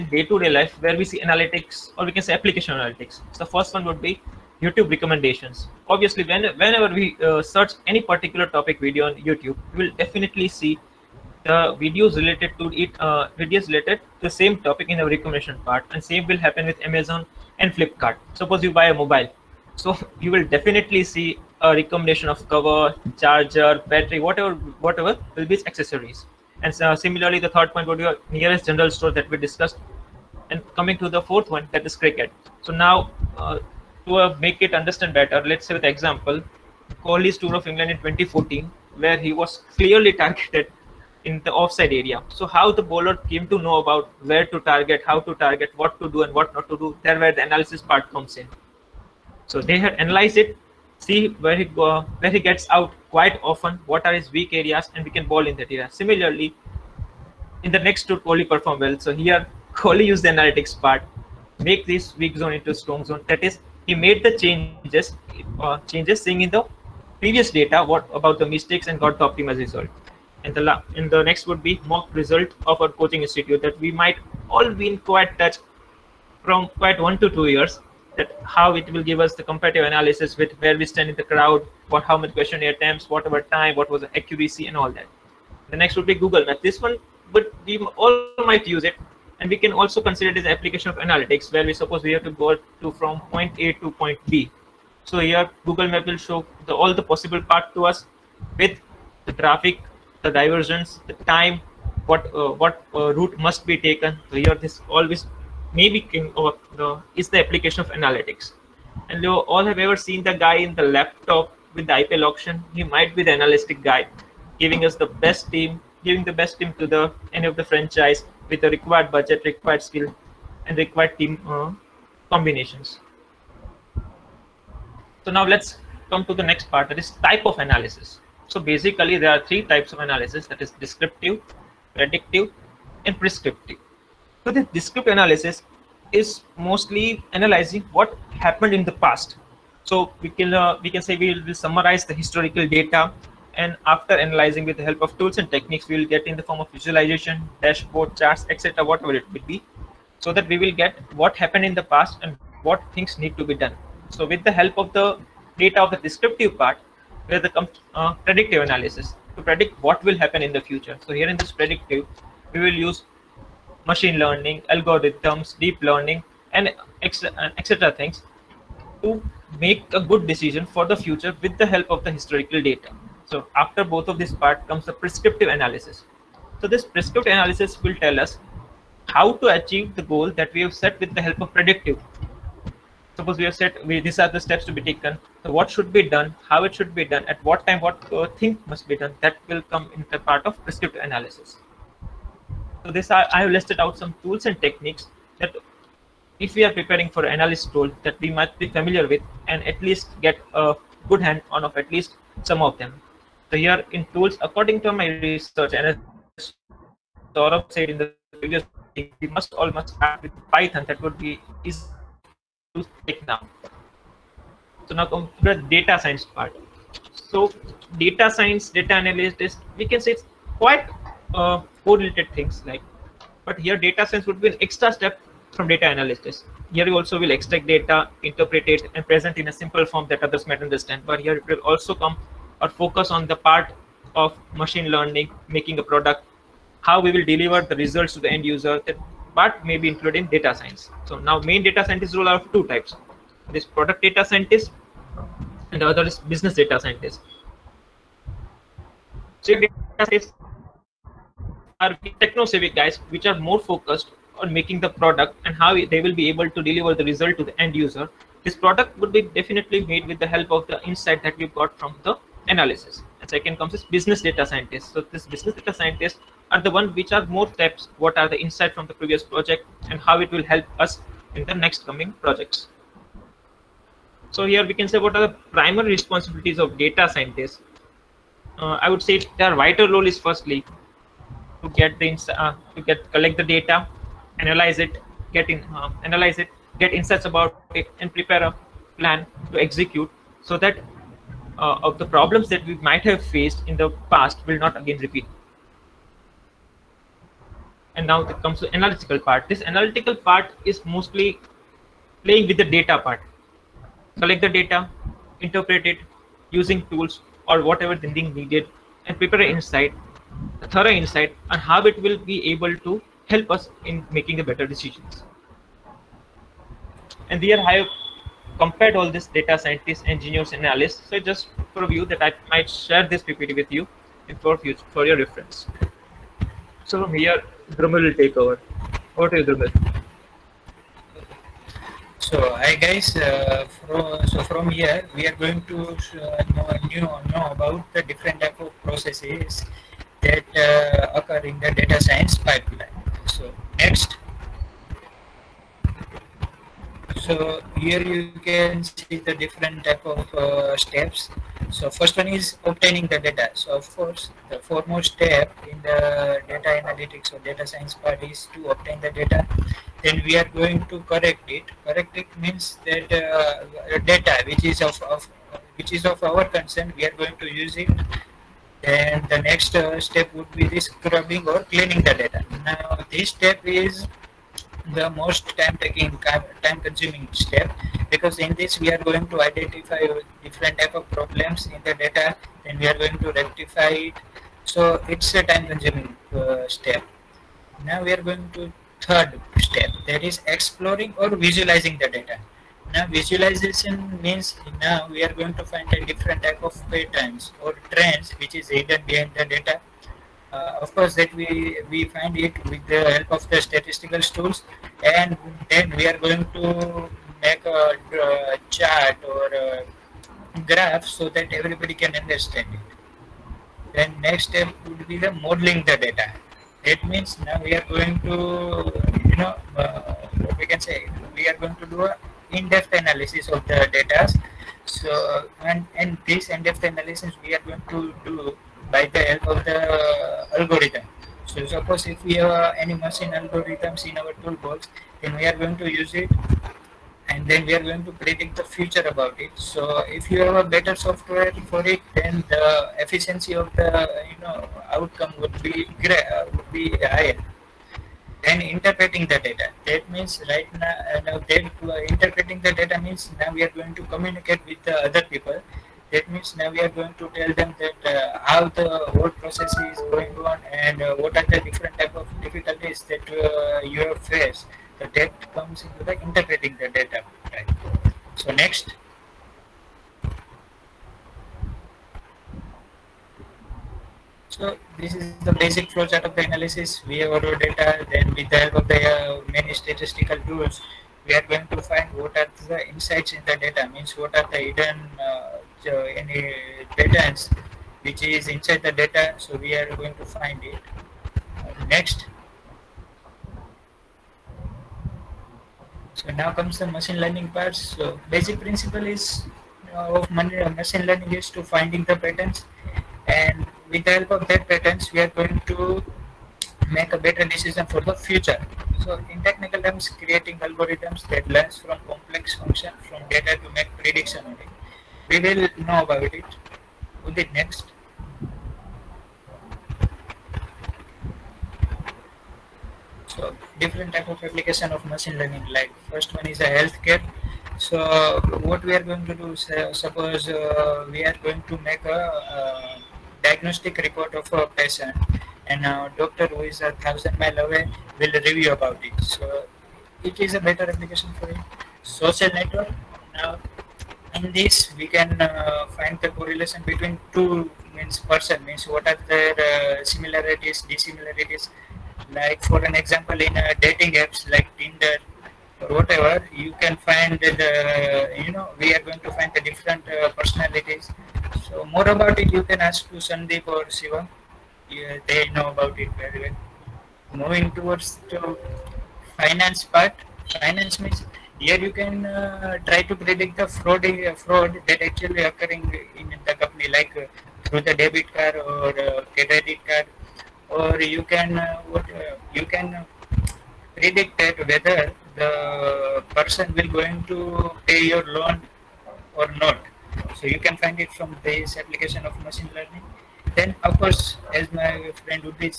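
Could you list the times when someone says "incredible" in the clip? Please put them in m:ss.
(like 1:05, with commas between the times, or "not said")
not said.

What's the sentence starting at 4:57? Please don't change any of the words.
And now it comes to analytical part.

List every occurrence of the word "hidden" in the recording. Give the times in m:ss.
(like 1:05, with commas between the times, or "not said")
6:38, 8:04.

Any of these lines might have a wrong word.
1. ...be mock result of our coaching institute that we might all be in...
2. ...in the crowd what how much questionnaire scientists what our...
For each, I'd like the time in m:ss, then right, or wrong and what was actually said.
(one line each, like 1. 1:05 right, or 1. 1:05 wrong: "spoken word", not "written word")
1. 1:11 right
2. 1:21 wrong: "attempts", not "scientists".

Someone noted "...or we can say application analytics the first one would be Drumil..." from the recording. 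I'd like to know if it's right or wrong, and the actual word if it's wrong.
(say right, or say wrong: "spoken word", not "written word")
wrong: "YouTube", not "Drumil".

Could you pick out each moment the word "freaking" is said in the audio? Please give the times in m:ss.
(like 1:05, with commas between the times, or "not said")
not said.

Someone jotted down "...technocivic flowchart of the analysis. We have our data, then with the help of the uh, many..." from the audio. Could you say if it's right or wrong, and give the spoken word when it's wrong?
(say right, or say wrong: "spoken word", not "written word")
wrong: "basic", not "technocivic".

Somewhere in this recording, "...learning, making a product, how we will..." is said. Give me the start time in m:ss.
3:54.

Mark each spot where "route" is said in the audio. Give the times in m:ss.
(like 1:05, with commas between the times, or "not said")
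1:43.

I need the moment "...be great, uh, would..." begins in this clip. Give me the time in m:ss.
7:25.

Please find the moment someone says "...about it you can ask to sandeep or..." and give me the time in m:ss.
9:22.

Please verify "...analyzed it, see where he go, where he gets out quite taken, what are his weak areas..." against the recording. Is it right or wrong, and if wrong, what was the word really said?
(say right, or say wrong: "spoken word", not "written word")
wrong: "often", not "taken".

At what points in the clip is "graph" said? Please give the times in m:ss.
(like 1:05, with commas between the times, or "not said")
6:50.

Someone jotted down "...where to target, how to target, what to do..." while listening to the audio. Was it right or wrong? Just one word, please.
right.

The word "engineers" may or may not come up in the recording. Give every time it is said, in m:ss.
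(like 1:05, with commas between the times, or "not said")
5:20.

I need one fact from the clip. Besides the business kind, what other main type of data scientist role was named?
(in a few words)
product data scientist.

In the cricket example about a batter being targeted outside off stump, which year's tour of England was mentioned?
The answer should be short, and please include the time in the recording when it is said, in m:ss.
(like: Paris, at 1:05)
2014, at 0:37.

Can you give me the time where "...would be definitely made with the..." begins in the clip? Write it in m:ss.
4:18.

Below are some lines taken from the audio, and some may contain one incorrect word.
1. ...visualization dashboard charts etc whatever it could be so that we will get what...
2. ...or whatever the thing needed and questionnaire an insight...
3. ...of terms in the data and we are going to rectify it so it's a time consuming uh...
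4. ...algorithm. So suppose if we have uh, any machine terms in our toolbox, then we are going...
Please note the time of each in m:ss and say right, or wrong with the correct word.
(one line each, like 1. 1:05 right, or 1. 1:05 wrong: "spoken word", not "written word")
1. 2:26 right
2. 5:07 wrong: "prepare", not "questionnaire"
3. 6:20 wrong: "problems", not "terms"
4. 7:10 wrong: "algorithms", not "terms".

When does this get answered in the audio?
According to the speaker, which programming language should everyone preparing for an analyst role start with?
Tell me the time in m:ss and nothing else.
3:30.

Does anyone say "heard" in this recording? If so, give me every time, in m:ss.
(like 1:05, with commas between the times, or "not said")
not said.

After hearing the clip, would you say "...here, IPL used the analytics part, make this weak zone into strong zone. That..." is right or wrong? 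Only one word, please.
wrong.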